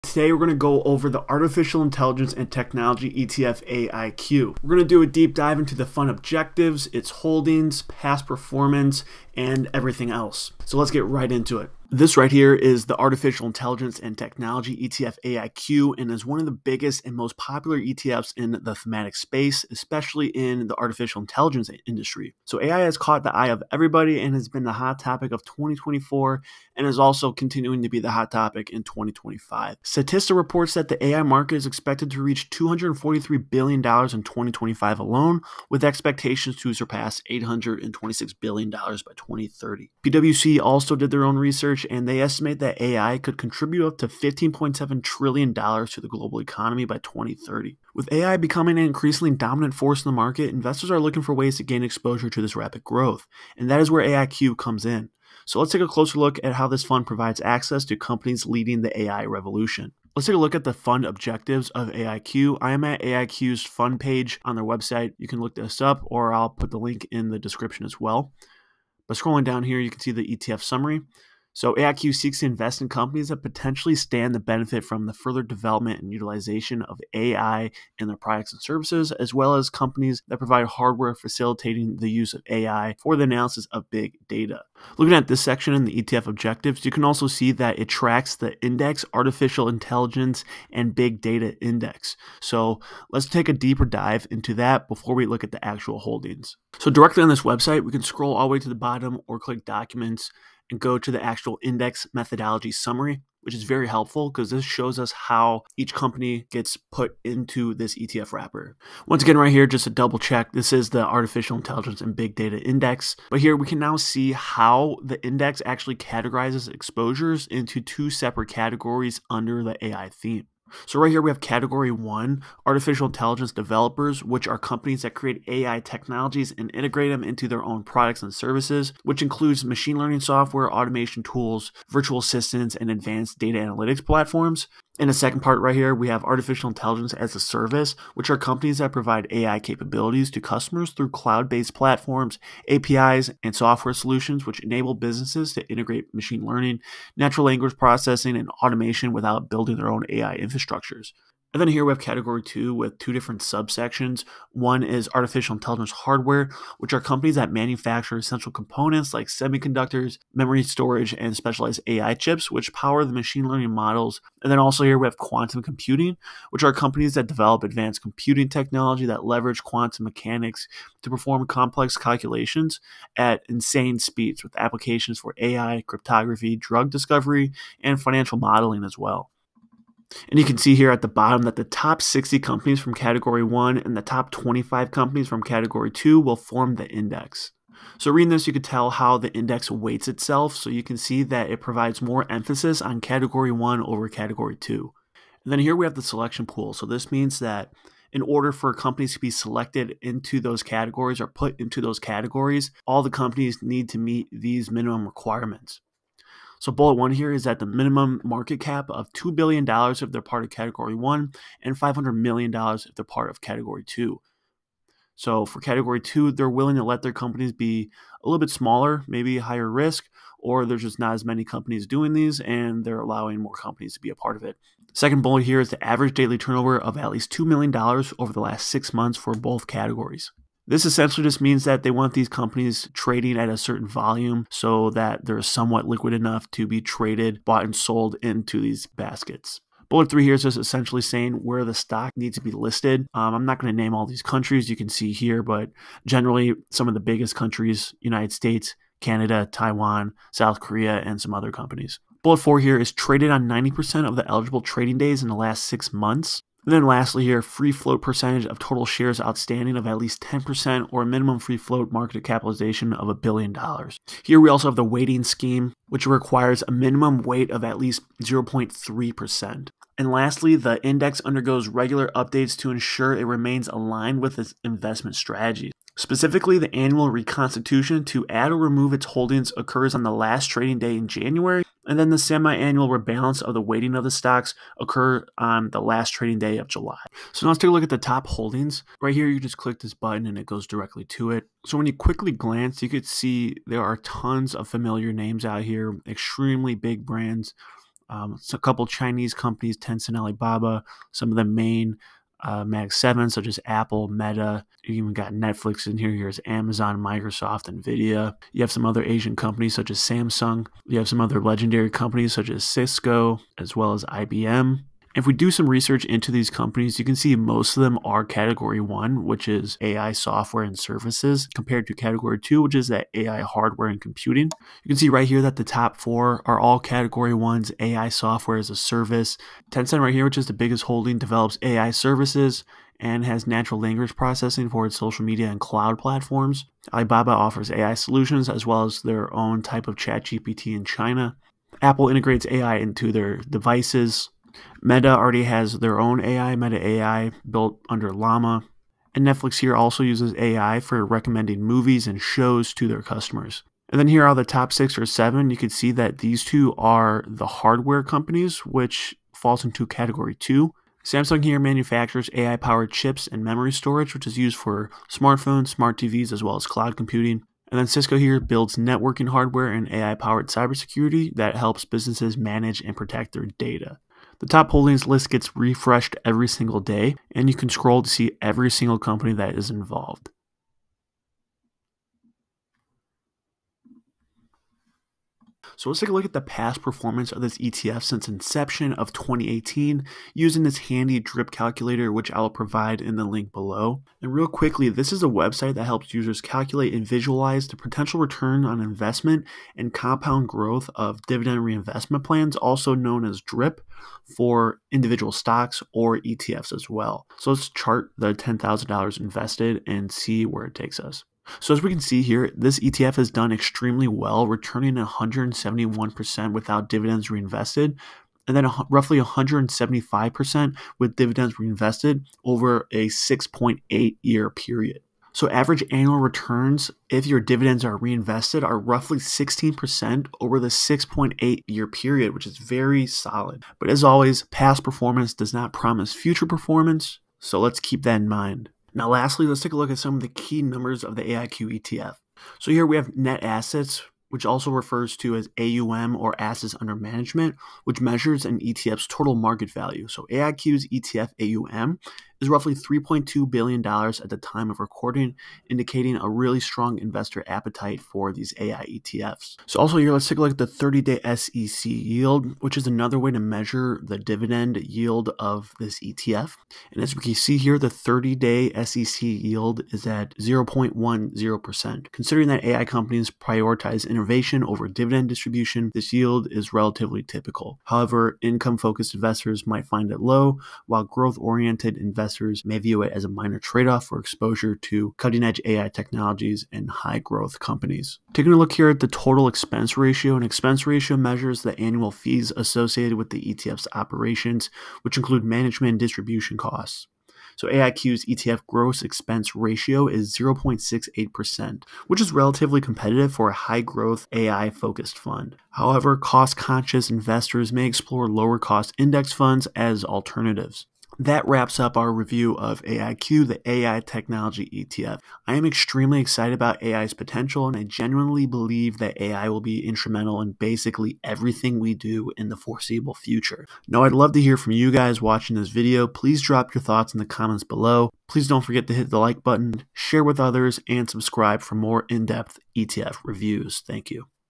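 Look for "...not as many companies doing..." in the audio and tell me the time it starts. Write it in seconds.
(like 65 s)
220 s.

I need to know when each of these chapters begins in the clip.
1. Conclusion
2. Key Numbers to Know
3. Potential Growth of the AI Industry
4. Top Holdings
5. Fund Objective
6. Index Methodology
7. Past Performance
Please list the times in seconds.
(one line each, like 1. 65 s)
1. 511 s
2. 439 s
3. 13 s
4. 287 s
5. 60 s
6. 94 s
7. 386 s.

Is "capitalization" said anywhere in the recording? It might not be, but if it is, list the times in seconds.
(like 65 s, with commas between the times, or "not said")
262 s.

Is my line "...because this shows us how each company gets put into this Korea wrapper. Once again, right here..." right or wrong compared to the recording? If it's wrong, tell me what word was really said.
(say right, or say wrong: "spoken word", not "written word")
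wrong: "ETF", not "Korea".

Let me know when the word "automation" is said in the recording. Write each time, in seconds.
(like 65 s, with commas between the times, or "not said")
130 s, 148 s.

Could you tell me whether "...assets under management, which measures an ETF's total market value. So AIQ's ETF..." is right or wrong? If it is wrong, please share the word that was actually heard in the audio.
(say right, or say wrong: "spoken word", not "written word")
right.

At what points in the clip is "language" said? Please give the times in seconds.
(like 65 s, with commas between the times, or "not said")
147 s, 333 s.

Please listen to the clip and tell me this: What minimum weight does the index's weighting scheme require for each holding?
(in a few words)
0.3%.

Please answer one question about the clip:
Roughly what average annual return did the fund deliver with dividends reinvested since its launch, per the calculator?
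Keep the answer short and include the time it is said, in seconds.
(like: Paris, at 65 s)
16%, at 429 s.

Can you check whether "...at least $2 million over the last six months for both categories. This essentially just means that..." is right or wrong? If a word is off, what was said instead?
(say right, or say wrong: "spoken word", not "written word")
right.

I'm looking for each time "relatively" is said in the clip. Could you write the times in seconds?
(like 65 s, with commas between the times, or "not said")
476 s, 502 s.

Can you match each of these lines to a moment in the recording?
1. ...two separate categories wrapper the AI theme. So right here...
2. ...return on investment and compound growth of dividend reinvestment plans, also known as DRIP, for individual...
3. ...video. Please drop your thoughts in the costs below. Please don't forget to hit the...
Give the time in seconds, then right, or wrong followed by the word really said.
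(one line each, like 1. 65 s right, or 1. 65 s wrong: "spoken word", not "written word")
1. 117 s wrong: "under", not "wrapper"
2. 398 s right
3. 525 s wrong: "comments", not "costs".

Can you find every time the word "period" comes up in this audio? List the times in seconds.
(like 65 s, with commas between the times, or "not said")
424 s, 431 s.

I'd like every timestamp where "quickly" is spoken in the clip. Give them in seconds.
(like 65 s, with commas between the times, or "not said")
291 s, 394 s.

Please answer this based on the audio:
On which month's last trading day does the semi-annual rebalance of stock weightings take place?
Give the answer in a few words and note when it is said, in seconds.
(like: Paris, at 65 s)
July, at 286 s.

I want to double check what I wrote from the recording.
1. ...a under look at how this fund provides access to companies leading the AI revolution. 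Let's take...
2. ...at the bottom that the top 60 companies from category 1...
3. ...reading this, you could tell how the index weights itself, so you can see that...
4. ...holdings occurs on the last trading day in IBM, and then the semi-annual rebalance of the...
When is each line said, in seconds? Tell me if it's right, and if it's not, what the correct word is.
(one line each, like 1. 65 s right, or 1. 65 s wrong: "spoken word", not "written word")
1. 55 s wrong: "closer", not "under"
2. 180 s right
3. 188 s right
4. 279 s wrong: "January", not "IBM".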